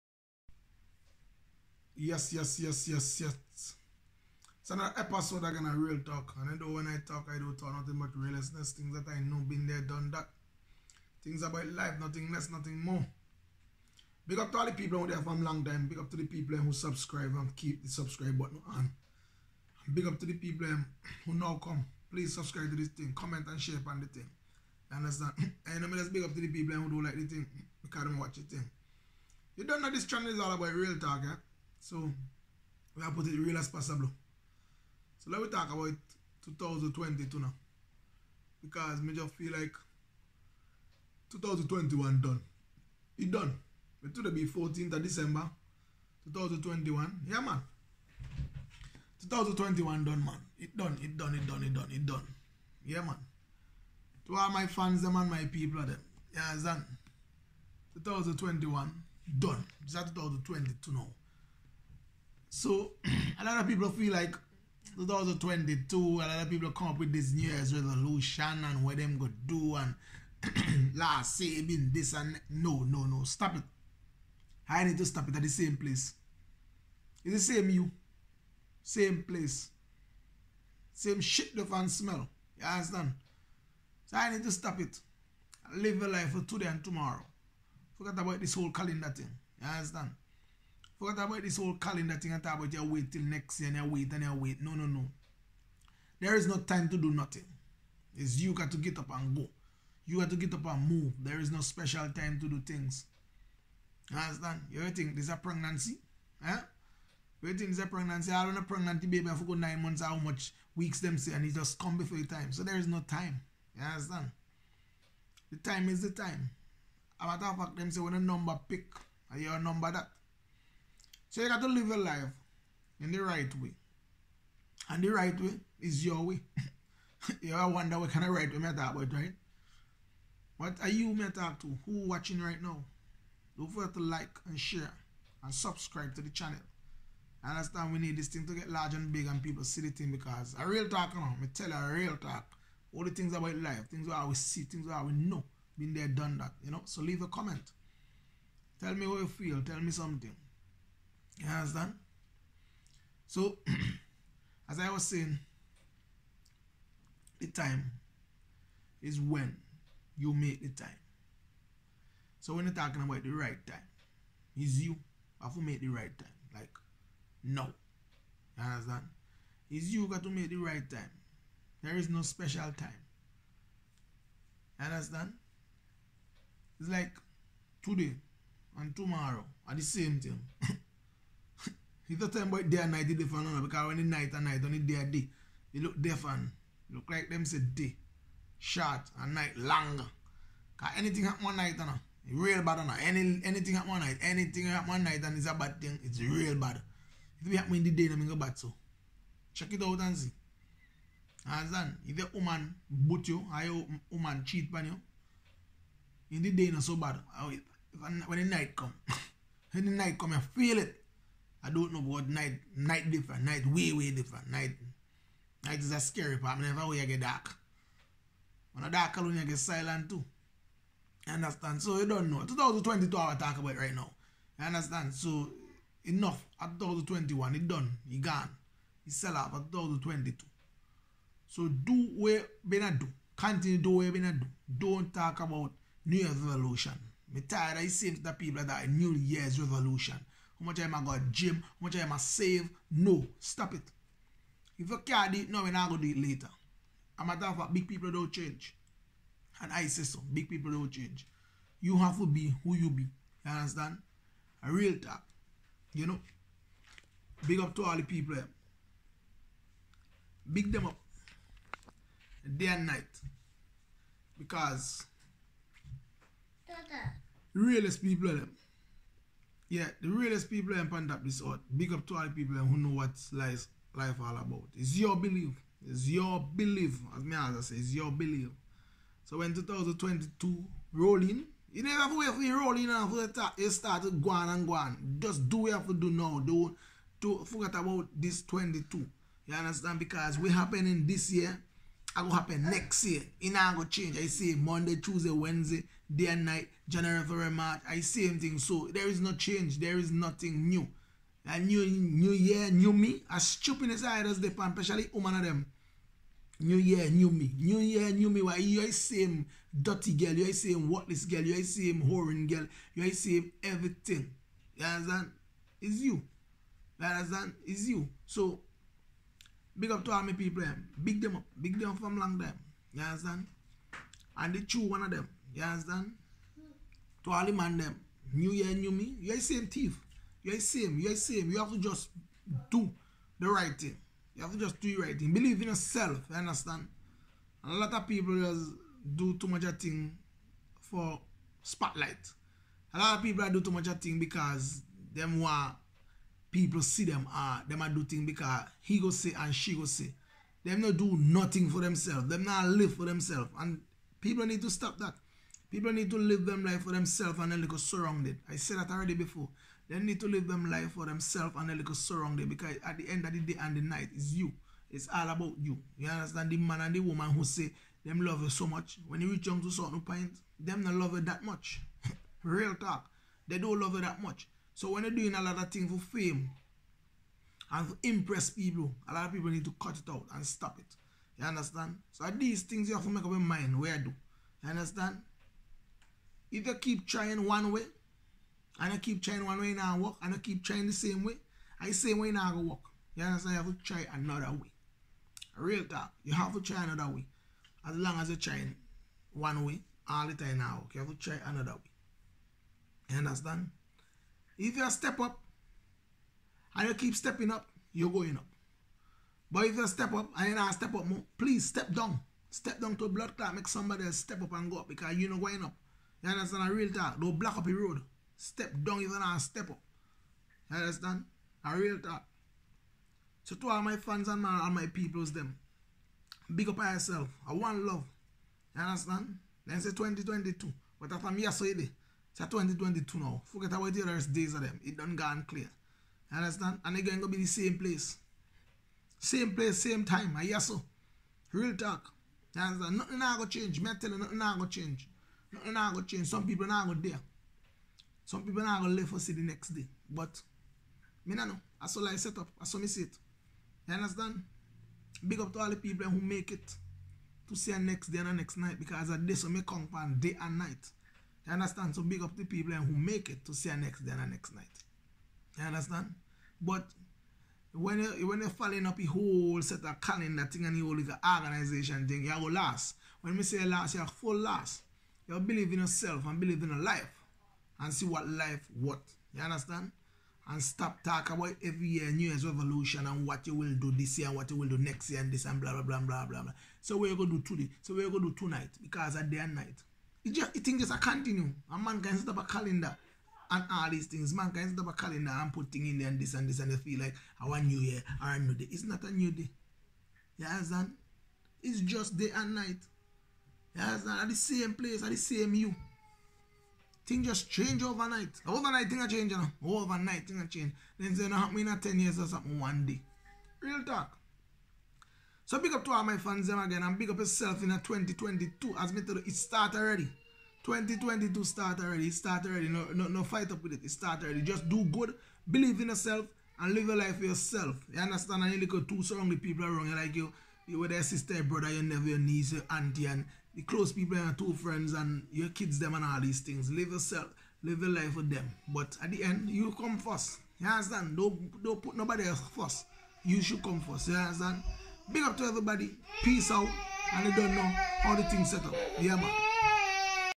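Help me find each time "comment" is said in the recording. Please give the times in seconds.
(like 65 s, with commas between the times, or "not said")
23 s, 147 s.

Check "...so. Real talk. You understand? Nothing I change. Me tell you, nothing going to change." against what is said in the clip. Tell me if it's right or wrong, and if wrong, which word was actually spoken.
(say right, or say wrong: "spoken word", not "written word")
right.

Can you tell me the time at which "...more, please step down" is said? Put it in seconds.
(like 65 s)
411 s.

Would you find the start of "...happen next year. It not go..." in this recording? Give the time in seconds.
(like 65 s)
292 s.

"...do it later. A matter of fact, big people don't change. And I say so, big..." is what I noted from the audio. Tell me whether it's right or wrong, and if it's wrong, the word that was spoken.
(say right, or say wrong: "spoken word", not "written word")
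right.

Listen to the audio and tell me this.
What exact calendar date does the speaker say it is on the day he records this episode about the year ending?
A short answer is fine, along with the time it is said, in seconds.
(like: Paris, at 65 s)
14th of December 2021, at 44 s.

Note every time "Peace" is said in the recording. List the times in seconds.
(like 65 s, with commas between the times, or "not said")
546 s.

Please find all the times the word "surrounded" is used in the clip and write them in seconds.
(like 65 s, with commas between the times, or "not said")
357 s, 362 s.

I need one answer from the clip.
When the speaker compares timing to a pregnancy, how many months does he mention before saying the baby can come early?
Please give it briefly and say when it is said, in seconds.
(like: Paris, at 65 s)
9, at 109 s.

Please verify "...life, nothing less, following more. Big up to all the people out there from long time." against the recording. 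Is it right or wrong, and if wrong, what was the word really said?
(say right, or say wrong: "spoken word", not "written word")
wrong: "nothing", not "following".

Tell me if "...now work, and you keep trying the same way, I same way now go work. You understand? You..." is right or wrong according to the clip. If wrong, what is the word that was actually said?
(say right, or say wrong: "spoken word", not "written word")
right.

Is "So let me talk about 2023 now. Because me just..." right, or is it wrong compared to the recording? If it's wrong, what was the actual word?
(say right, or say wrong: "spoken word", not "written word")
wrong: "2022", not "2023".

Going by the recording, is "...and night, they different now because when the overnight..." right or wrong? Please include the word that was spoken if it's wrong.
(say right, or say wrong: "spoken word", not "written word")
wrong: "night", not "overnight".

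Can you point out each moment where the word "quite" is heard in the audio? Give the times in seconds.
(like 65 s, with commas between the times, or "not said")
not said.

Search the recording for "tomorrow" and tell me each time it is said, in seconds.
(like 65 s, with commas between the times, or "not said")
86 s, 178 s.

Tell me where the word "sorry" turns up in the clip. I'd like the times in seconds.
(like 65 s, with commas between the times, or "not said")
not said.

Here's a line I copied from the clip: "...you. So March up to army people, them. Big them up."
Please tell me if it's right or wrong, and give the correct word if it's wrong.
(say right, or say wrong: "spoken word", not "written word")
wrong: "Big", not "March".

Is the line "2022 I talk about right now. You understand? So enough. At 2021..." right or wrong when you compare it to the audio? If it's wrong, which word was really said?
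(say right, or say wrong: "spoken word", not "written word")
right.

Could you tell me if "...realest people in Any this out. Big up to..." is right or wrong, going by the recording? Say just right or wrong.
wrong.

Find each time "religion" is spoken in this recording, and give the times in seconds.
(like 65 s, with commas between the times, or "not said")
not said.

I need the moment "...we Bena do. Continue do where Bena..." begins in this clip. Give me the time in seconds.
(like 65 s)
232 s.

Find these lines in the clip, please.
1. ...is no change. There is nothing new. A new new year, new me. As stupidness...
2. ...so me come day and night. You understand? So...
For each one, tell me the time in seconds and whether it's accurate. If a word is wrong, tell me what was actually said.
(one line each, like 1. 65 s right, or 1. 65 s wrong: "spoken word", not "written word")
1. 299 s right
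2. 459 s right.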